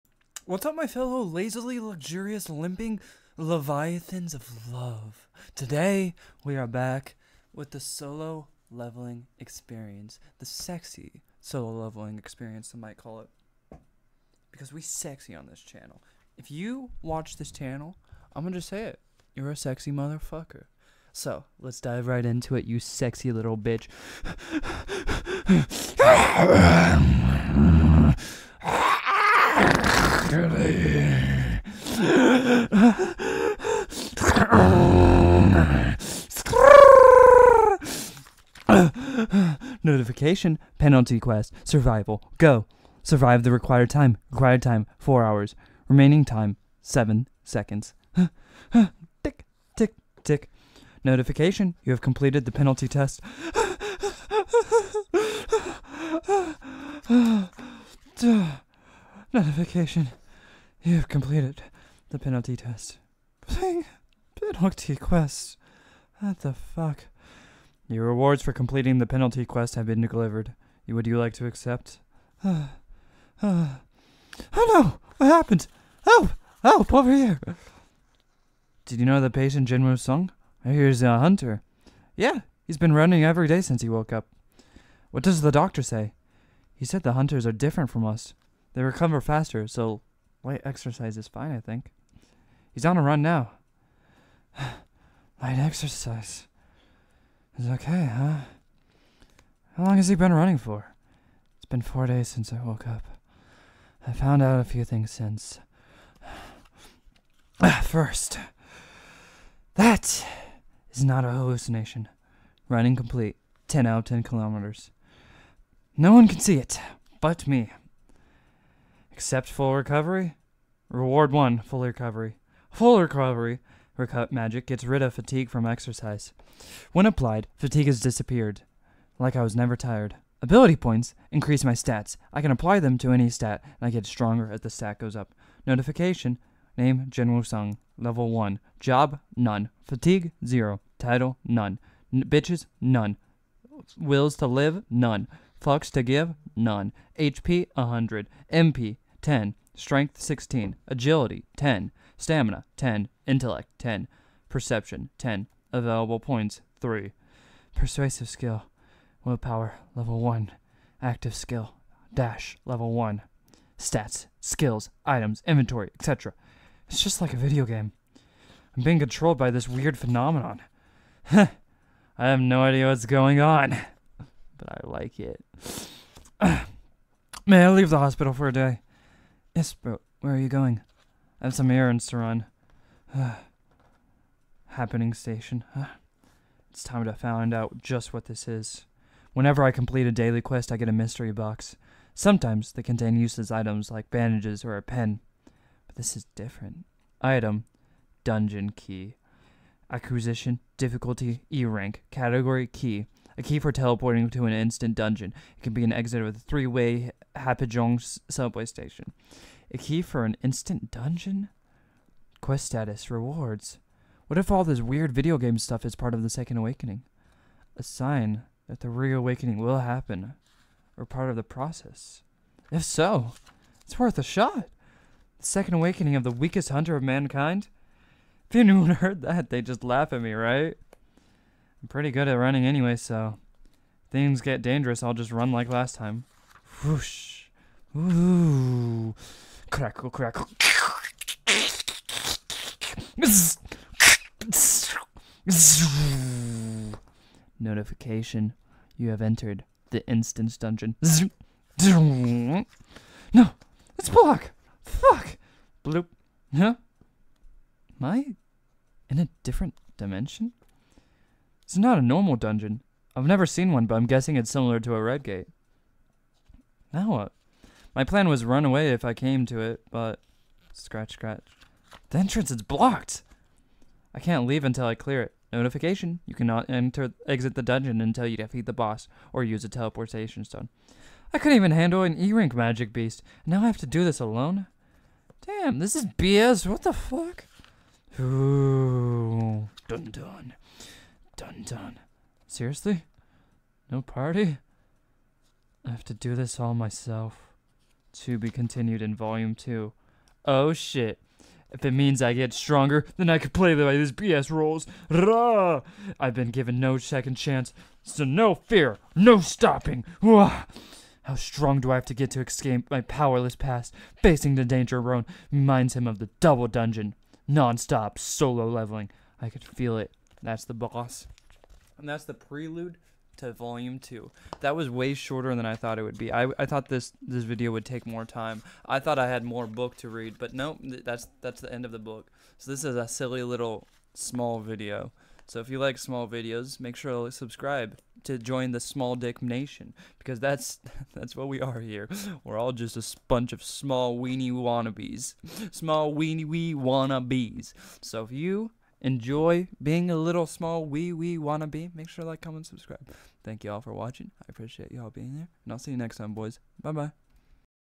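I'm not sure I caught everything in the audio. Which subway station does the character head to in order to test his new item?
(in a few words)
Hapjeong station.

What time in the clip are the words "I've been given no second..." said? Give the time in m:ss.
5:06.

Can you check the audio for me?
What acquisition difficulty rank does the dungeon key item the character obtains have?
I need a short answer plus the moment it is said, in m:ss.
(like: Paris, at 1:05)
E rank, at 3:21.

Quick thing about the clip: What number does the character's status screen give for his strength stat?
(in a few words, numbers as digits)
16.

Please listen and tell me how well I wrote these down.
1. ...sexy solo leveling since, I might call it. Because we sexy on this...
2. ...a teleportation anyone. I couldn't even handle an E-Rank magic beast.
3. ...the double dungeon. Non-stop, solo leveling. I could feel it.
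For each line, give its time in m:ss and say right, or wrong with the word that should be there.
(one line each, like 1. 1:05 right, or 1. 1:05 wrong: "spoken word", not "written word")
1. 0:10 wrong: "experience", not "since"
2. 4:39 wrong: "stone", not "anyone"
3. 5:16 right.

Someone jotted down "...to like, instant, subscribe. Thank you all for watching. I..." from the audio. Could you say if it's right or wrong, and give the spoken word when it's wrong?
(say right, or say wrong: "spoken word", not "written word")
wrong: "comment", not "instant".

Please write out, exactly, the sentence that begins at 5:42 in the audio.
We're all just a bunch of small weenie wannabes, small weenie wee wannabes.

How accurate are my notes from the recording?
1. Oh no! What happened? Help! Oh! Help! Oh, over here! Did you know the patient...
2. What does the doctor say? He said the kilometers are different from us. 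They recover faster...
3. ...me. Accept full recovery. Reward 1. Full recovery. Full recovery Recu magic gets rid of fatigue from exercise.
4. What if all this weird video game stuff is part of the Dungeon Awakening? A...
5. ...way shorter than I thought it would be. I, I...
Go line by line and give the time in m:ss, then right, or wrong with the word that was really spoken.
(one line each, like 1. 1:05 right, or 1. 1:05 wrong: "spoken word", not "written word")
1. 1:14 right
2. 1:25 wrong: "hunters", not "kilometers"
3. 1:57 right
4. 3:34 wrong: "Second", not "Dungeon"
5. 5:24 right.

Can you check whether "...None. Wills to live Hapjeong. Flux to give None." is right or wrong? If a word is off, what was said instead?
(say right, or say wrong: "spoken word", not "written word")
wrong: "None", not "Hapjeong".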